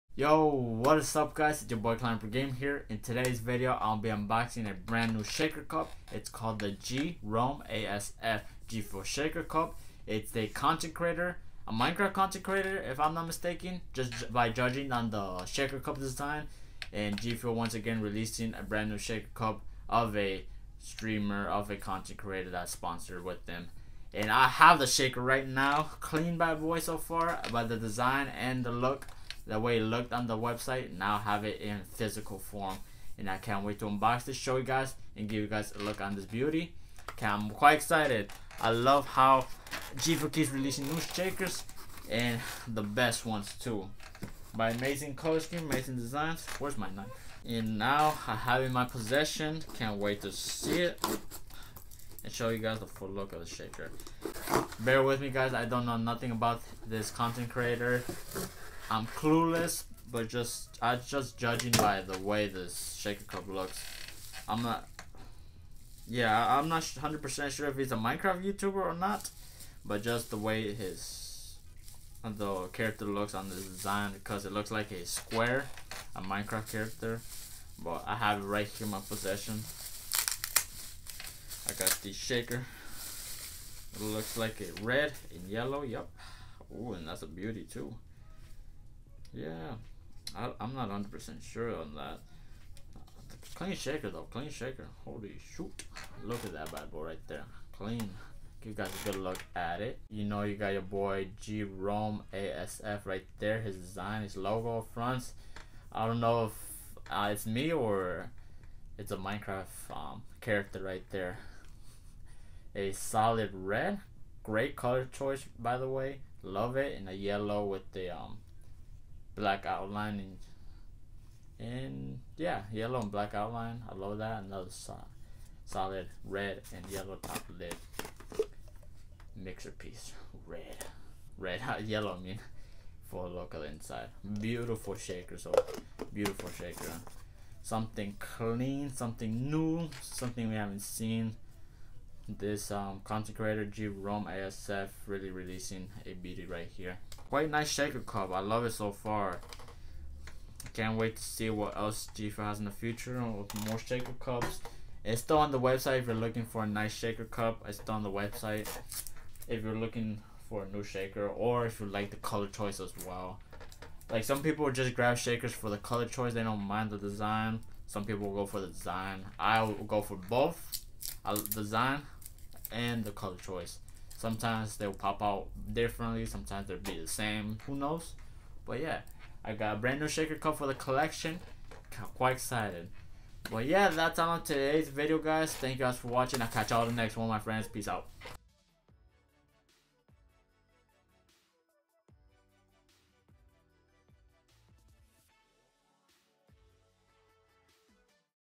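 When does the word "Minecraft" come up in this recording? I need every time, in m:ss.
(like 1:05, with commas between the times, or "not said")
0:11, 1:07, 1:16, 1:49.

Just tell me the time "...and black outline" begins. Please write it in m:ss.
2:03.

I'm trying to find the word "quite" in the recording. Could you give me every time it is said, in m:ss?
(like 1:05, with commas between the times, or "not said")
0:37, 2:27, 3:02.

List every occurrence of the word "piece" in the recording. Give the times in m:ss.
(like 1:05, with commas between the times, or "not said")
2:09.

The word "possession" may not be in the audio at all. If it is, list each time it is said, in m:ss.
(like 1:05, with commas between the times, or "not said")
0:48, 1:18.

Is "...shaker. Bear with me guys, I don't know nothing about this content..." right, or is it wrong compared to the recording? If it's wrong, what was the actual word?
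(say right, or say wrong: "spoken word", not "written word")
right.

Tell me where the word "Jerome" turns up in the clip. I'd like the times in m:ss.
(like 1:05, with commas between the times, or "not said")
0:06, 1:41.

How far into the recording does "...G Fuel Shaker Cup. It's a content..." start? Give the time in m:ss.
0:08.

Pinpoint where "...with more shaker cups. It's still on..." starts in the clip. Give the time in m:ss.
2:33.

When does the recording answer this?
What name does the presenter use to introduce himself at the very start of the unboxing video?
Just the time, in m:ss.
0:01.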